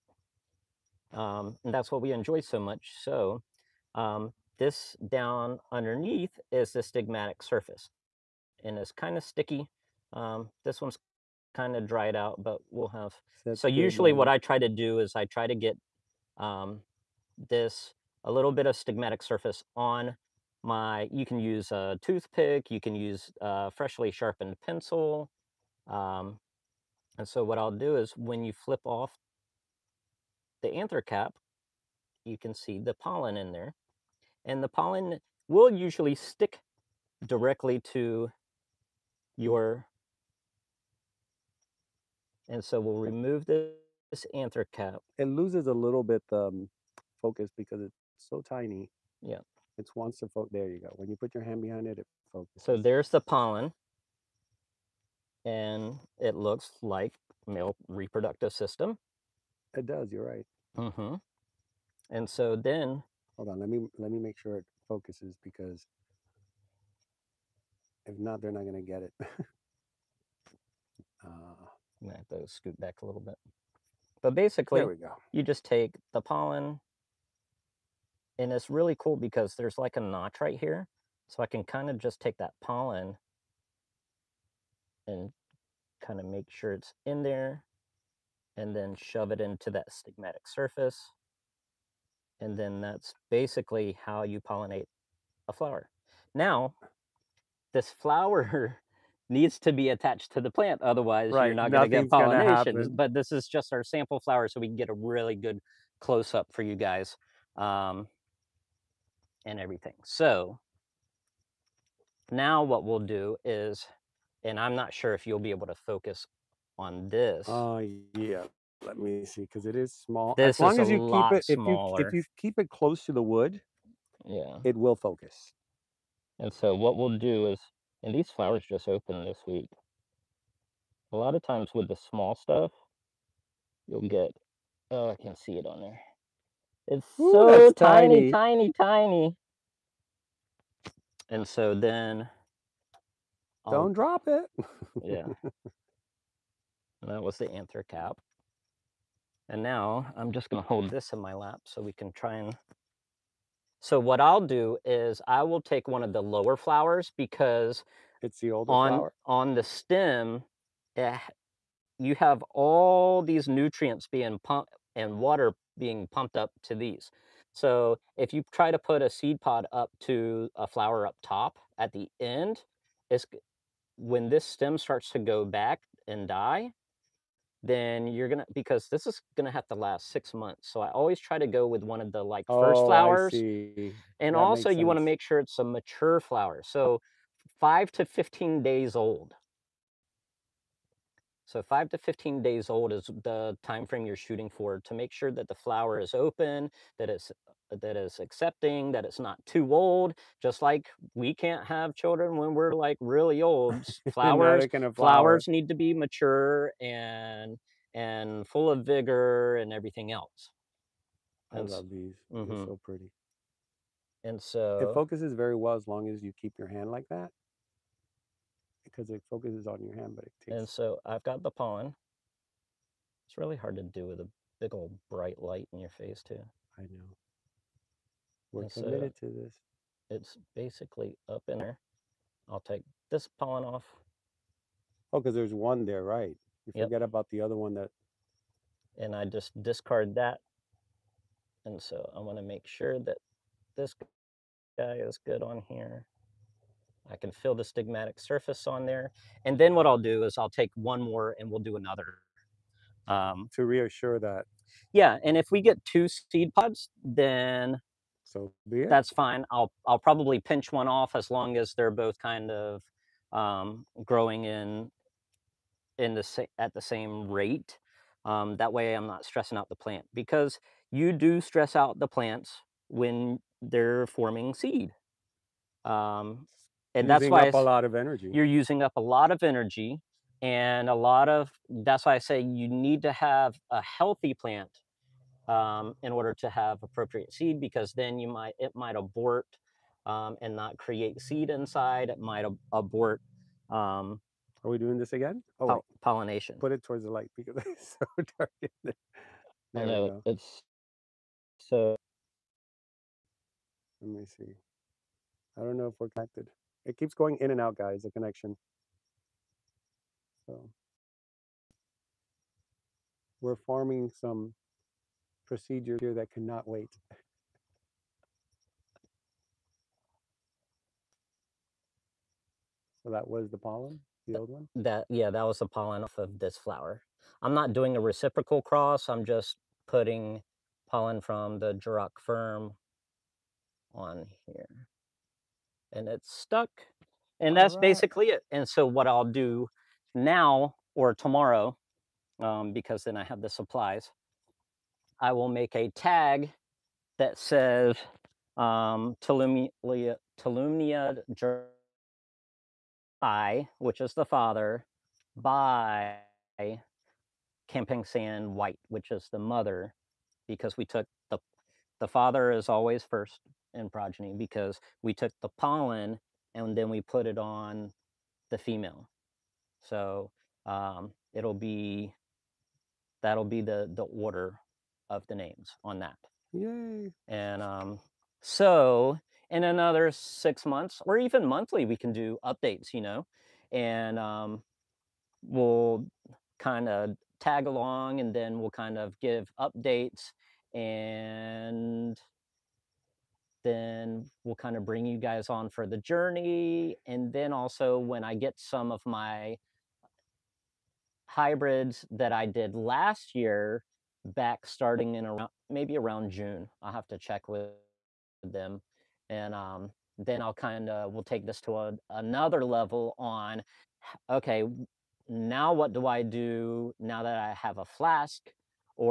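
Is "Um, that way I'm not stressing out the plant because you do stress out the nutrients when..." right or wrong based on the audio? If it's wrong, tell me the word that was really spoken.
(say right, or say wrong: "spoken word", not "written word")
wrong: "plants", not "nutrients".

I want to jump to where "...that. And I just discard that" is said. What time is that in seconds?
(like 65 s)
237 s.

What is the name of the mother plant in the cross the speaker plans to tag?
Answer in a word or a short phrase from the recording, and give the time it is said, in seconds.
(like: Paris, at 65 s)
Camping Sand White, at 357 s.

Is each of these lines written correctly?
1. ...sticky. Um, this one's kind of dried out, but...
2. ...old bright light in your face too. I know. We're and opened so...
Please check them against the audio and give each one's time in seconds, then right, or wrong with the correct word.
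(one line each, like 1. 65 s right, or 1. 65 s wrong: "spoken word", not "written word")
1. 9 s right
2. 224 s wrong: "committed", not "opened".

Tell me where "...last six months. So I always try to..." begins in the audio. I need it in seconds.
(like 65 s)
179 s.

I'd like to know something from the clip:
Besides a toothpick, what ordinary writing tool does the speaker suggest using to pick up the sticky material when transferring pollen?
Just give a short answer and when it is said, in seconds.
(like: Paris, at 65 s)
freshly sharpened pencil, at 23 s.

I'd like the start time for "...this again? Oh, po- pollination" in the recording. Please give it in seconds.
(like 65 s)
294 s.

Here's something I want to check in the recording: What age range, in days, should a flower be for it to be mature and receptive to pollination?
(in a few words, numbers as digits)
5 to 15 days.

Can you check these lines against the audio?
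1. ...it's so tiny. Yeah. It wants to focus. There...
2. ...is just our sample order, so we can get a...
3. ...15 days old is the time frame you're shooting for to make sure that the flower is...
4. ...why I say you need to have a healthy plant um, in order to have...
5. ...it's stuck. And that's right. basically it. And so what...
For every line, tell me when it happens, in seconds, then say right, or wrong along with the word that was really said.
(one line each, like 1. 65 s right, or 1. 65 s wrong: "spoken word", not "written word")
1. 47 s right
2. 103 s wrong: "flower", not "order"
3. 191 s right
4. 282 s right
5. 336 s right.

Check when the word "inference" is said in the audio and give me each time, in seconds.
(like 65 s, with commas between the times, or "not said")
not said.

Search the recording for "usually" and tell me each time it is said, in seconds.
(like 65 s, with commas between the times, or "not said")
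13 s, 35 s.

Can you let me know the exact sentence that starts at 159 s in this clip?
On the stem, eh, you have all these nutrients being pumped and water being pumped up to these.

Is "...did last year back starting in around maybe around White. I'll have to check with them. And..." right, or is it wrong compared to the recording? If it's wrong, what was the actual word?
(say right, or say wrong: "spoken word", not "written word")
wrong: "June", not "White".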